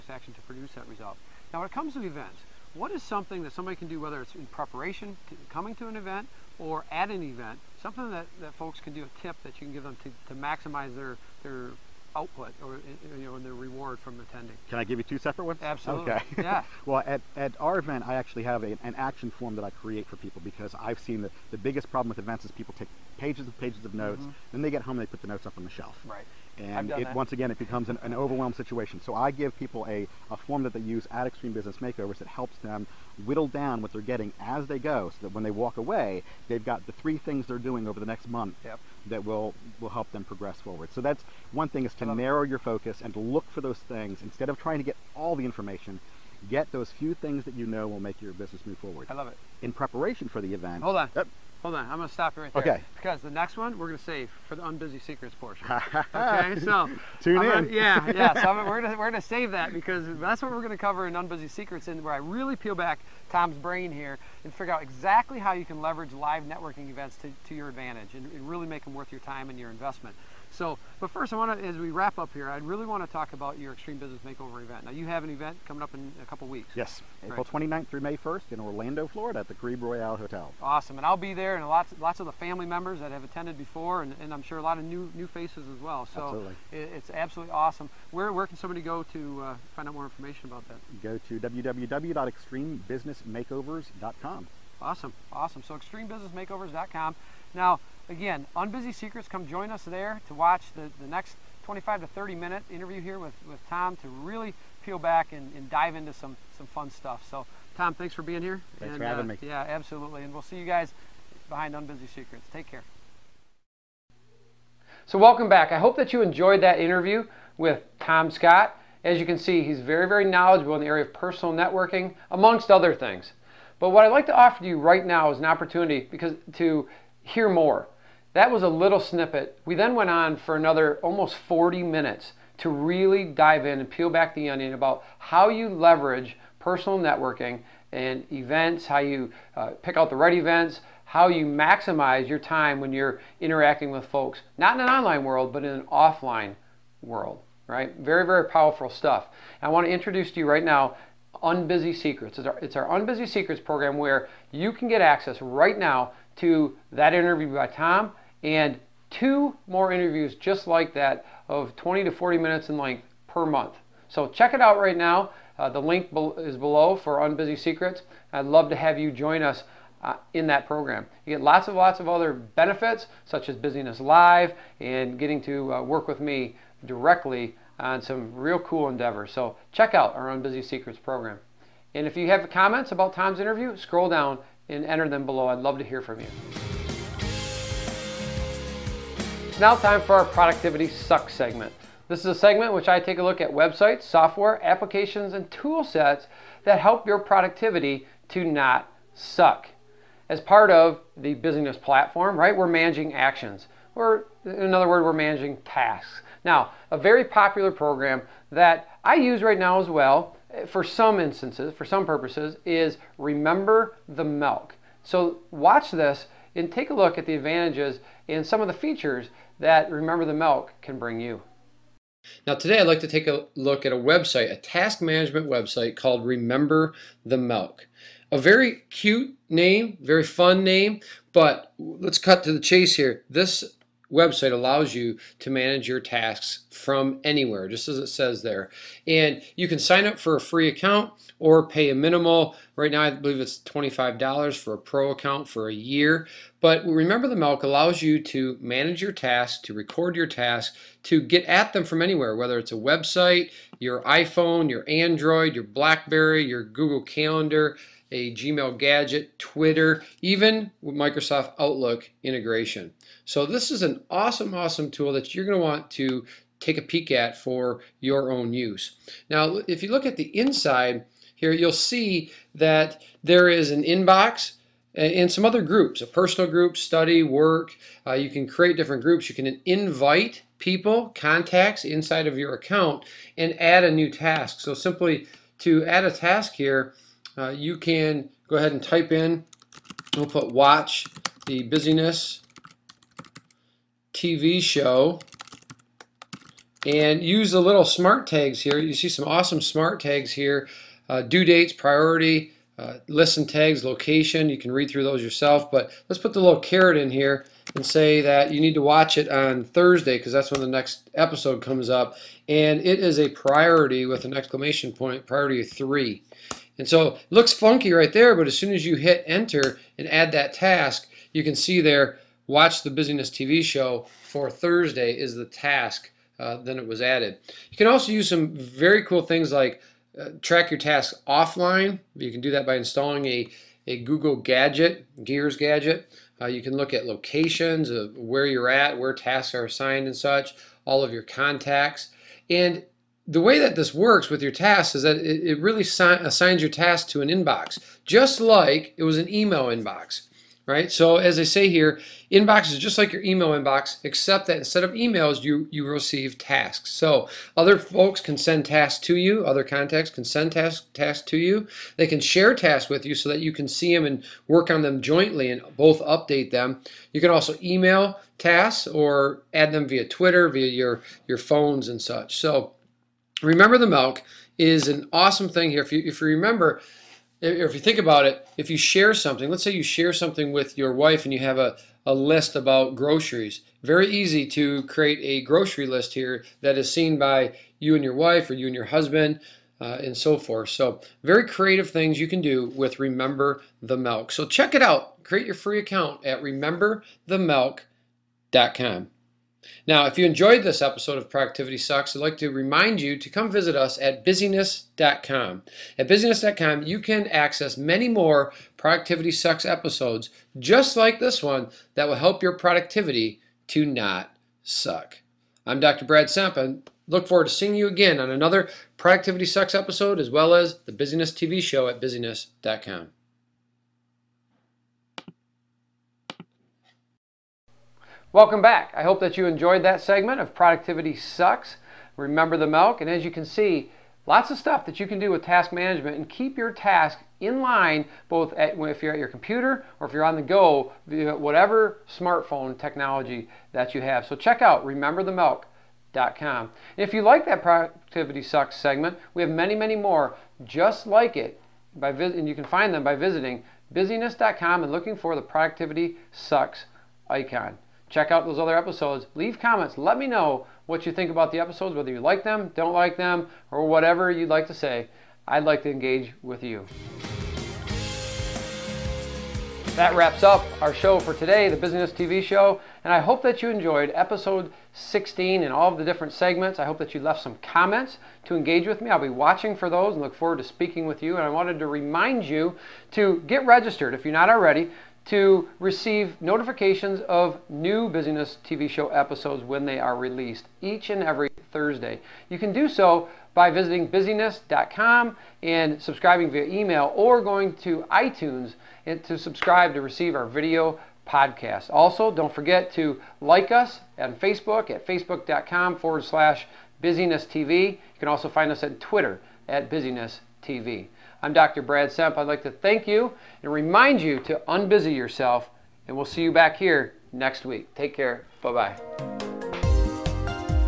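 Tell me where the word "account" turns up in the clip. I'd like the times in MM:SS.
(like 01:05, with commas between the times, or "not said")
04:00, 04:05, 04:42, 06:35.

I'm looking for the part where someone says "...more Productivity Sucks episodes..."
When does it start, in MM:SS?
06:48.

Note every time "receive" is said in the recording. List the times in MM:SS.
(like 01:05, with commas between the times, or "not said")
05:55, 08:05, 08:20.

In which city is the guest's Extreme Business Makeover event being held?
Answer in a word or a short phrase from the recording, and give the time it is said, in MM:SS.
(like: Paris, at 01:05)
Orlando, Florida, at 01:18.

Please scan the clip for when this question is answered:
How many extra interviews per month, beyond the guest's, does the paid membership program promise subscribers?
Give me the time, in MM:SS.
02:39.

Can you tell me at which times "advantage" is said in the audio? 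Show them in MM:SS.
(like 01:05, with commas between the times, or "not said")
01:07, 03:37.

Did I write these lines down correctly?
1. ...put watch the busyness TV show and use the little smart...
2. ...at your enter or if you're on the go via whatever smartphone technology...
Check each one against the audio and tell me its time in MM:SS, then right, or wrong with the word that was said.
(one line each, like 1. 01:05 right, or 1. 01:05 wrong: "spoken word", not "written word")
1. 04:50 right
2. 07:19 wrong: "computer", not "enter".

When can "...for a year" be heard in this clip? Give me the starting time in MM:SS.
04:05.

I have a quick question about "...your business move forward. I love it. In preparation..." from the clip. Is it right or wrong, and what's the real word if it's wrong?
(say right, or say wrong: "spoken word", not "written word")
right.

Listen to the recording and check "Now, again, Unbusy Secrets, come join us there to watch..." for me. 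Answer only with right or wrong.
right.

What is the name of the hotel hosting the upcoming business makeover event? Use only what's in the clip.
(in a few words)
Grebe Royale Hotel.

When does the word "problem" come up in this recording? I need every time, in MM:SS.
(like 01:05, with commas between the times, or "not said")
00:21.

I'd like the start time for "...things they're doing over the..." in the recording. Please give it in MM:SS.
00:37.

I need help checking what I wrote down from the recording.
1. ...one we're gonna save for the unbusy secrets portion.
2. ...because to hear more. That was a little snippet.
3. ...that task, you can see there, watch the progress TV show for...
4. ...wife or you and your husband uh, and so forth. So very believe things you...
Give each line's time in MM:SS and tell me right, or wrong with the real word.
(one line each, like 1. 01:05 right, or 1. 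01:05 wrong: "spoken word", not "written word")
1. 00:53 right
2. 02:06 right
3. 05:20 wrong: "busyness", not "progress"
4. 06:28 wrong: "creative", not "believe".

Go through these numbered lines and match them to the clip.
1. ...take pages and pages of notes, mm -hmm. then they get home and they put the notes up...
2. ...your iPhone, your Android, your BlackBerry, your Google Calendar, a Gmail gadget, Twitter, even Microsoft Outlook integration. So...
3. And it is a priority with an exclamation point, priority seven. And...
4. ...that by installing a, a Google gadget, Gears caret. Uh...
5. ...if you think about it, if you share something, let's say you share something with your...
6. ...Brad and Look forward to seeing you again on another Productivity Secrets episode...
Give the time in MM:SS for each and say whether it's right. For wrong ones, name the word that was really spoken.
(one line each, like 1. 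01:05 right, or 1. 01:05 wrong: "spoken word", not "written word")
1. 00:22 right
2. 04:13 right
3. 05:12 wrong: "three", not "seven"
4. 05:32 wrong: "gadget", not "caret"
5. 06:17 right
6. 06:56 wrong: "Sucks", not "Secrets".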